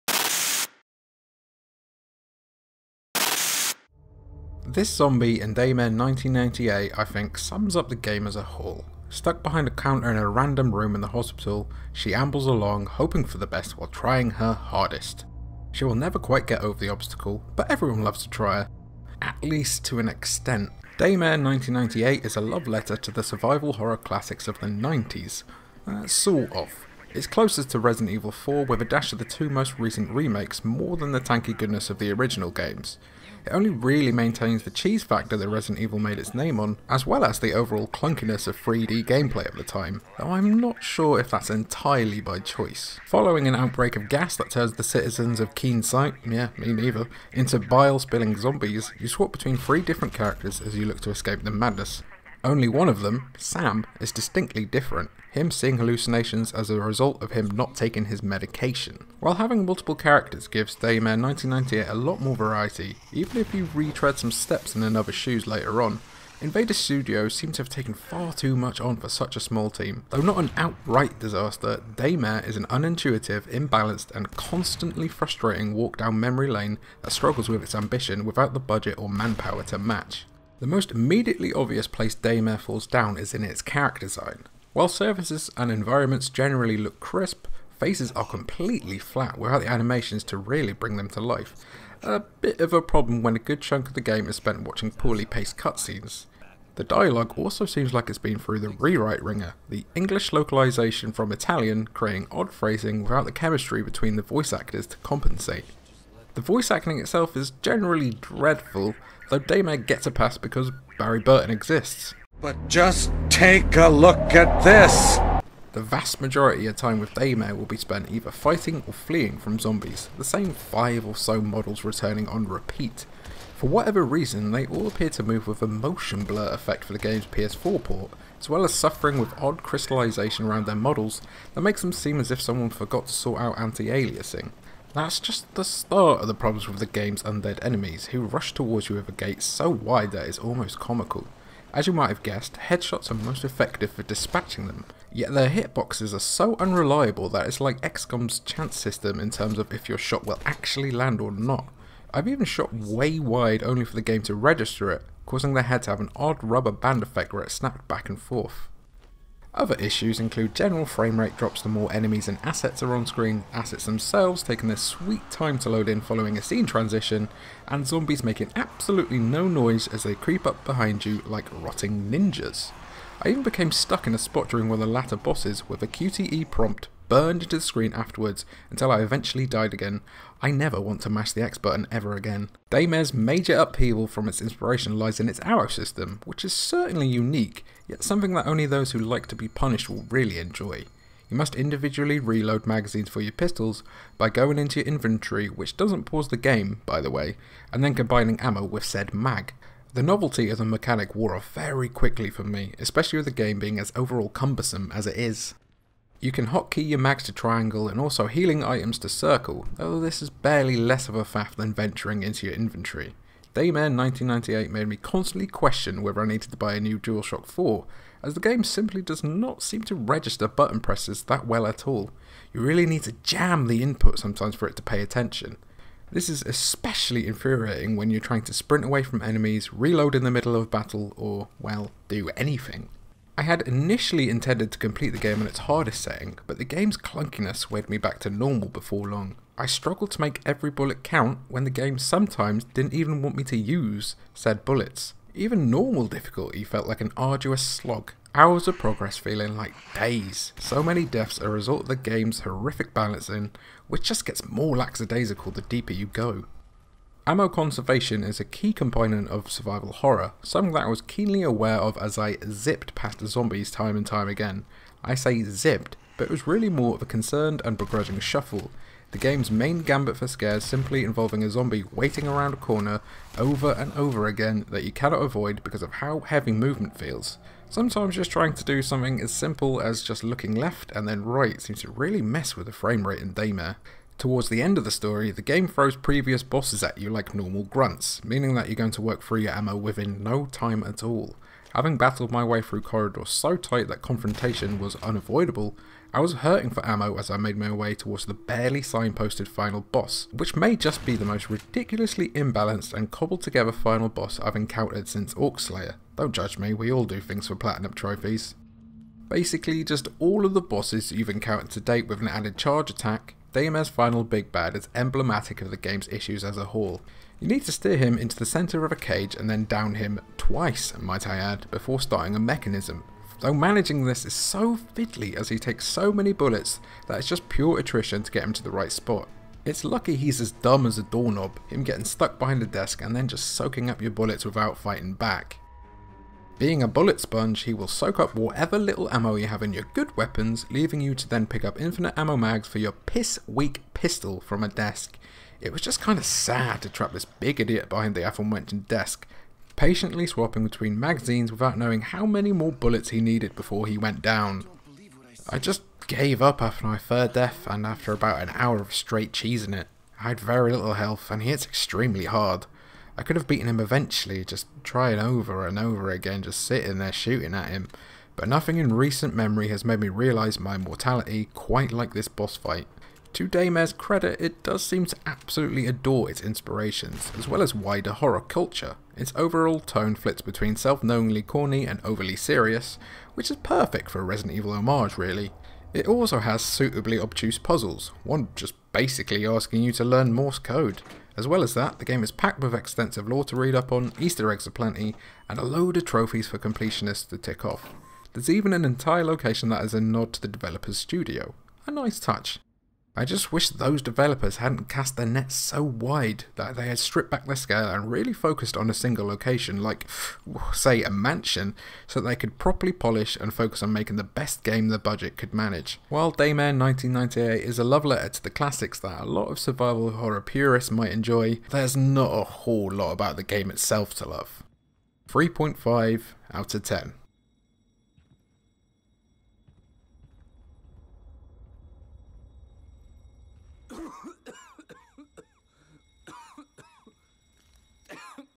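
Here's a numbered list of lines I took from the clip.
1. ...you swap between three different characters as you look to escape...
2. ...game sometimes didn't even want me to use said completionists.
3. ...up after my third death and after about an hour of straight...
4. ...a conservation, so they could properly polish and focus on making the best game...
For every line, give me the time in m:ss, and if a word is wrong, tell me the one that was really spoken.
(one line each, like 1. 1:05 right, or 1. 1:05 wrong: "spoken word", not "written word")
1. 0:48 right
2. 4:01 wrong: "bullets", not "completionists"
3. 5:56 right
4. 6:51 wrong: "mansion", not "conservation".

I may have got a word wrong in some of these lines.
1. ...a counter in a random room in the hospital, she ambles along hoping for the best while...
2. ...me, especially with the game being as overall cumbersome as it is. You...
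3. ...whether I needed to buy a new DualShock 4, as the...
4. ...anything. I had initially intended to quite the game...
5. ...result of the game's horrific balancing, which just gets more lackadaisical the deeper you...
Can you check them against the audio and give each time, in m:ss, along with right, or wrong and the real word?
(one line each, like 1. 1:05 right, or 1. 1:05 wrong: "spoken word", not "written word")
1. 0:09 right
2. 3:22 right
3. 3:36 right
4. 3:52 wrong: "complete", not "quite"
5. 4:11 right.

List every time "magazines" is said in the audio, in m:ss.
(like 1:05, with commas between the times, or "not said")
3:12, 5:50.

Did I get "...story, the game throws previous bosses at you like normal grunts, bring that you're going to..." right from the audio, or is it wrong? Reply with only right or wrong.
wrong.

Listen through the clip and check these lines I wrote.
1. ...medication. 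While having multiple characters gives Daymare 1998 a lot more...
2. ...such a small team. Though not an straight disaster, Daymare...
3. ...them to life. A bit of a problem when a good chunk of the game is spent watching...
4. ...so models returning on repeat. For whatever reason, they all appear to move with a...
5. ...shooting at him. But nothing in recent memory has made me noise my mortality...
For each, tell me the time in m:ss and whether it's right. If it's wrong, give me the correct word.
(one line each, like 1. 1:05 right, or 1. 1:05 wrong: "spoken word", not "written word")
1. 0:58 right
2. 1:09 wrong: "outright", not "straight"
3. 1:30 right
4. 2:01 right
5. 6:07 wrong: "realise", not "noise".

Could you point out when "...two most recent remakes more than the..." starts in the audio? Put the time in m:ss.
0:29.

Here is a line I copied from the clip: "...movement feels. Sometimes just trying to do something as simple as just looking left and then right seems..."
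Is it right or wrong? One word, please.
right.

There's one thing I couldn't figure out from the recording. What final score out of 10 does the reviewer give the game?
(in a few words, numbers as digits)
3.5.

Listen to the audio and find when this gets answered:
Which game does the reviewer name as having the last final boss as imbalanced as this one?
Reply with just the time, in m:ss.
5:05.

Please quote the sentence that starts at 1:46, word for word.
The voice acting itself is generally dreadful, though Daymare gets a pass because Barry Burton exists.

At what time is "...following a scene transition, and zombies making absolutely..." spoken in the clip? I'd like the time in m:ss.
2:45.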